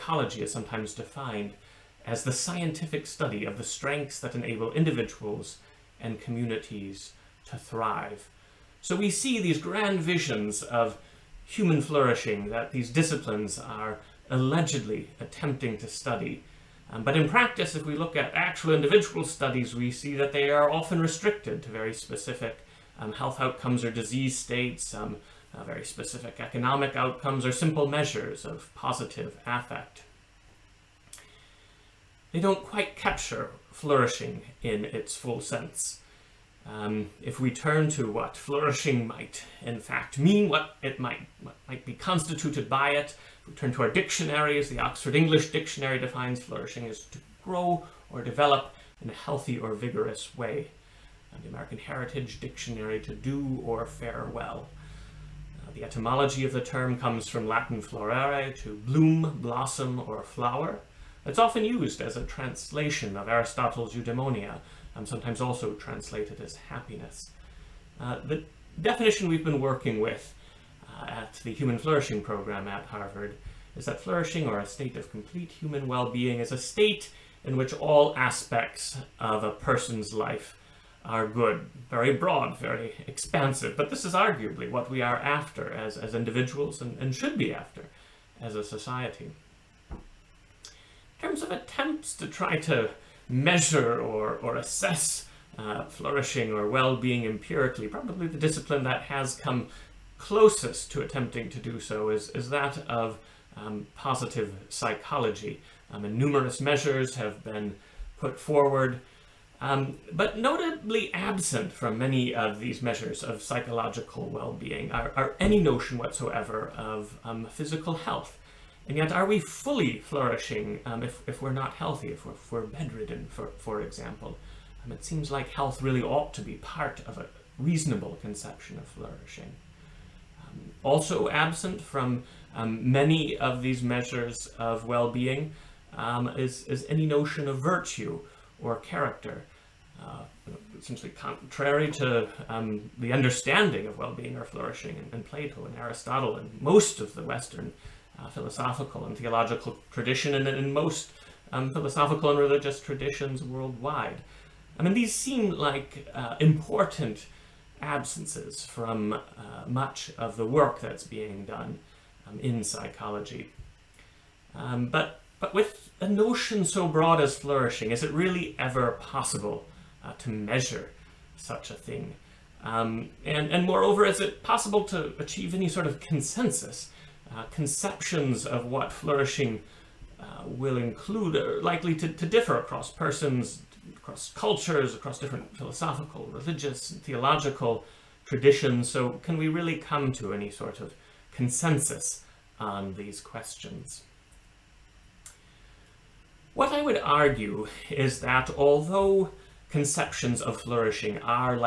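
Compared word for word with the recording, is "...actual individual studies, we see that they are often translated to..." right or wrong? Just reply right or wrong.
wrong.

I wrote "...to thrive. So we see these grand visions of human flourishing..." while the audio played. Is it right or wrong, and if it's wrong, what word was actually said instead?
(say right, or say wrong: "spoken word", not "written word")
right.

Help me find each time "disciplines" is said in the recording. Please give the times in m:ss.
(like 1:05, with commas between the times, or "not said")
0:12, 1:38.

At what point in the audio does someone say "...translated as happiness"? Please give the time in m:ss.
1:05.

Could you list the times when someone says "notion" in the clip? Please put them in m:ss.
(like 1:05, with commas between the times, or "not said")
1:55, 2:17, 2:46.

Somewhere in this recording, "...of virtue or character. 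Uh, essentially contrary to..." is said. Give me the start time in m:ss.
2:17.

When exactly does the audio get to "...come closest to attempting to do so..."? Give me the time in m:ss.
1:39.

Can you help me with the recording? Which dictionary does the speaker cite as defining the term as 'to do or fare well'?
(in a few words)
American Heritage Dictionary.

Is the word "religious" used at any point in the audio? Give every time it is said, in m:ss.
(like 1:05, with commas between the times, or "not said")
2:32, 3:06.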